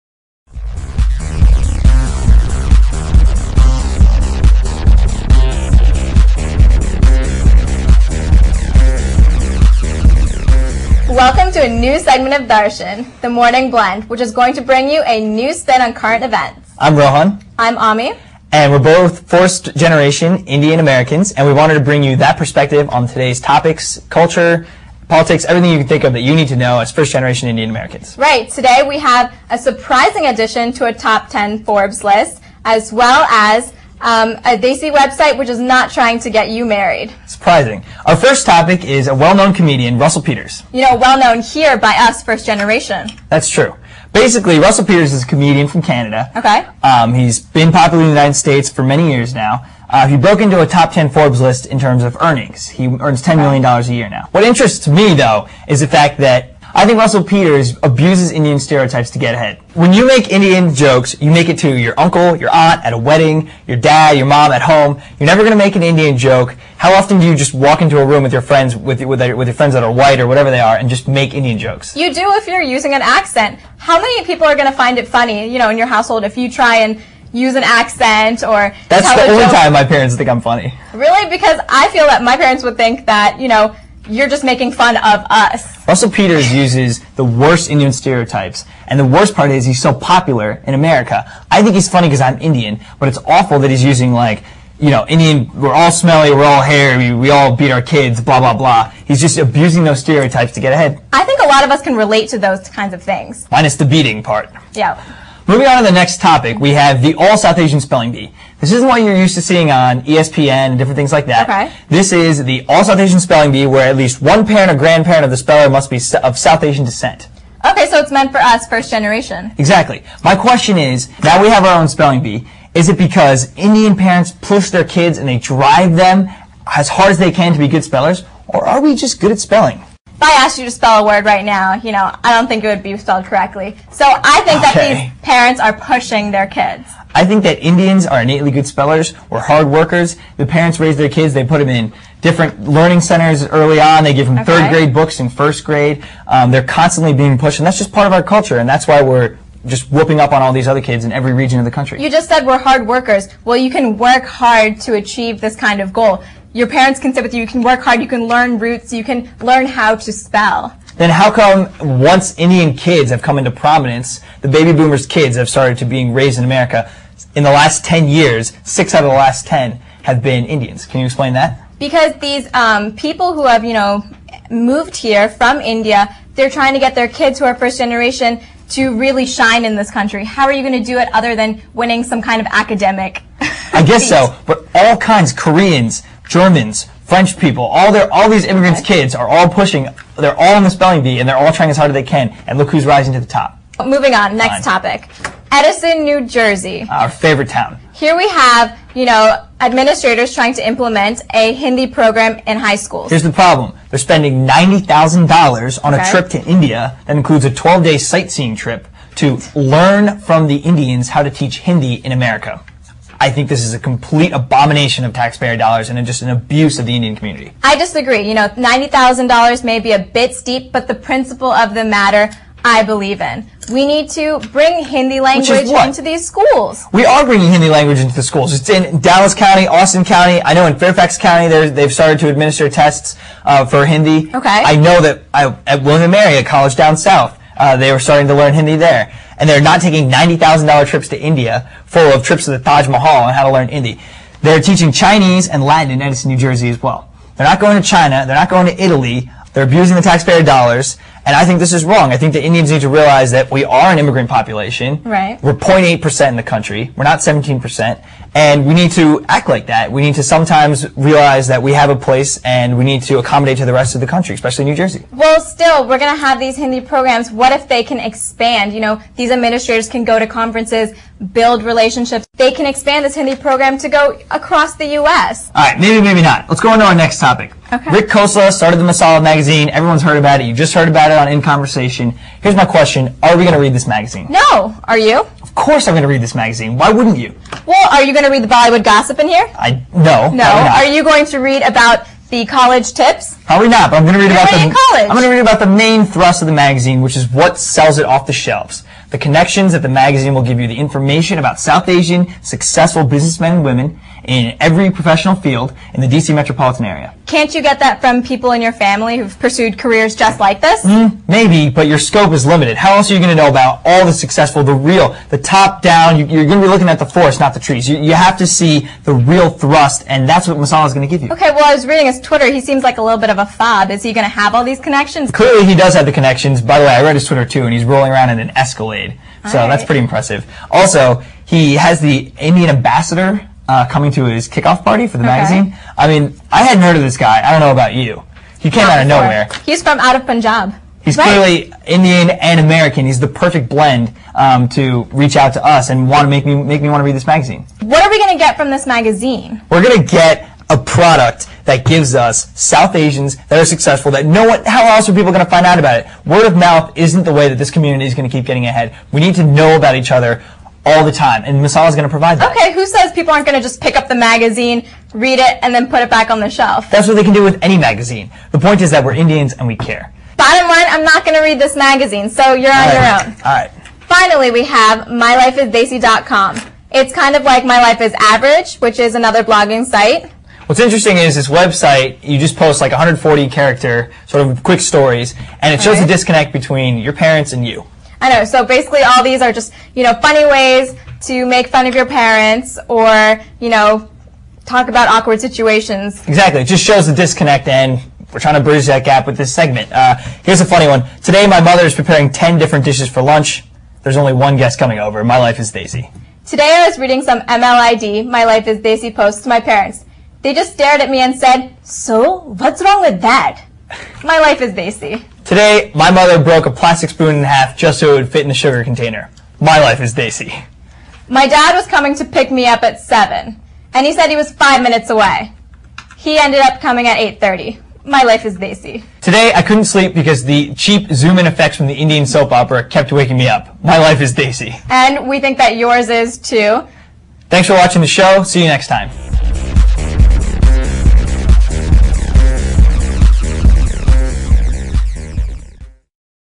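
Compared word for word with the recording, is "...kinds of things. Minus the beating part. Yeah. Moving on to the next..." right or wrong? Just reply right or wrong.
right.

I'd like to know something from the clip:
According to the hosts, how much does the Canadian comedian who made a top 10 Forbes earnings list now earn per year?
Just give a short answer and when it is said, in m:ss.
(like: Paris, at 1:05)
$10 million, at 0:53.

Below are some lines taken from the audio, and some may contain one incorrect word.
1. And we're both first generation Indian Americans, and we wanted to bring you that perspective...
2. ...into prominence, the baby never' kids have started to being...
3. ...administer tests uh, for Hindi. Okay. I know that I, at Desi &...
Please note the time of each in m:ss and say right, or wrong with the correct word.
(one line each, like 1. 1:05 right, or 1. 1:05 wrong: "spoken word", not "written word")
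1. 0:18 right
2. 2:43 wrong: "boomers", not "never"
3. 3:52 wrong: "William", not "Desi".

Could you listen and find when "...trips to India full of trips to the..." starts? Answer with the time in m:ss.
4:00.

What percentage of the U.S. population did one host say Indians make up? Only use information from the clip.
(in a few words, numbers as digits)
0.8%.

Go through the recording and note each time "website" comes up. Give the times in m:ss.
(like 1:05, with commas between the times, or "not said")
0:34, 6:21.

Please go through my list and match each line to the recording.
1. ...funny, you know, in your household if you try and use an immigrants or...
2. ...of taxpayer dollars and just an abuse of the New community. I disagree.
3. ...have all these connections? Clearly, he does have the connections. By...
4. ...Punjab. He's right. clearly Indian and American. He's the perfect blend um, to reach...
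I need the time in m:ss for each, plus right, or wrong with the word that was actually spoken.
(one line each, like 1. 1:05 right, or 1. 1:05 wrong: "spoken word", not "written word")
1. 1:15 wrong: "accent", not "immigrants"
2. 3:35 wrong: "Indian", not "New"
3. 5:24 right
4. 5:40 right.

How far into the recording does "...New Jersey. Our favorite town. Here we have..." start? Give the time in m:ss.
3:16.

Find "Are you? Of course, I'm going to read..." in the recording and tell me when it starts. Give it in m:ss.
4:44.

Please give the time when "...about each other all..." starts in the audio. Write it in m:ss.
5:59.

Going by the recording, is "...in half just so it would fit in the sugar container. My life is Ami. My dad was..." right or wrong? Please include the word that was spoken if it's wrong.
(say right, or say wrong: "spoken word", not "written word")
wrong: "Desi", not "Ami".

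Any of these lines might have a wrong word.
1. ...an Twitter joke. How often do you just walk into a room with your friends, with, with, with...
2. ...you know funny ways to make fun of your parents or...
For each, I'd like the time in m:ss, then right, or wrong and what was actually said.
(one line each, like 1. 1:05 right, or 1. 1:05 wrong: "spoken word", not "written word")
1. 1:05 wrong: "Indian", not "Twitter"
2. 6:29 right.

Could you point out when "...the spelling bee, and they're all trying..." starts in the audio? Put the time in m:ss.
3:10.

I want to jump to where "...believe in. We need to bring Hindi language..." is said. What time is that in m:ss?
3:42.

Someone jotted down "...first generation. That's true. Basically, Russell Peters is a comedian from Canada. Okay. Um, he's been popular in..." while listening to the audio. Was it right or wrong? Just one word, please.
right.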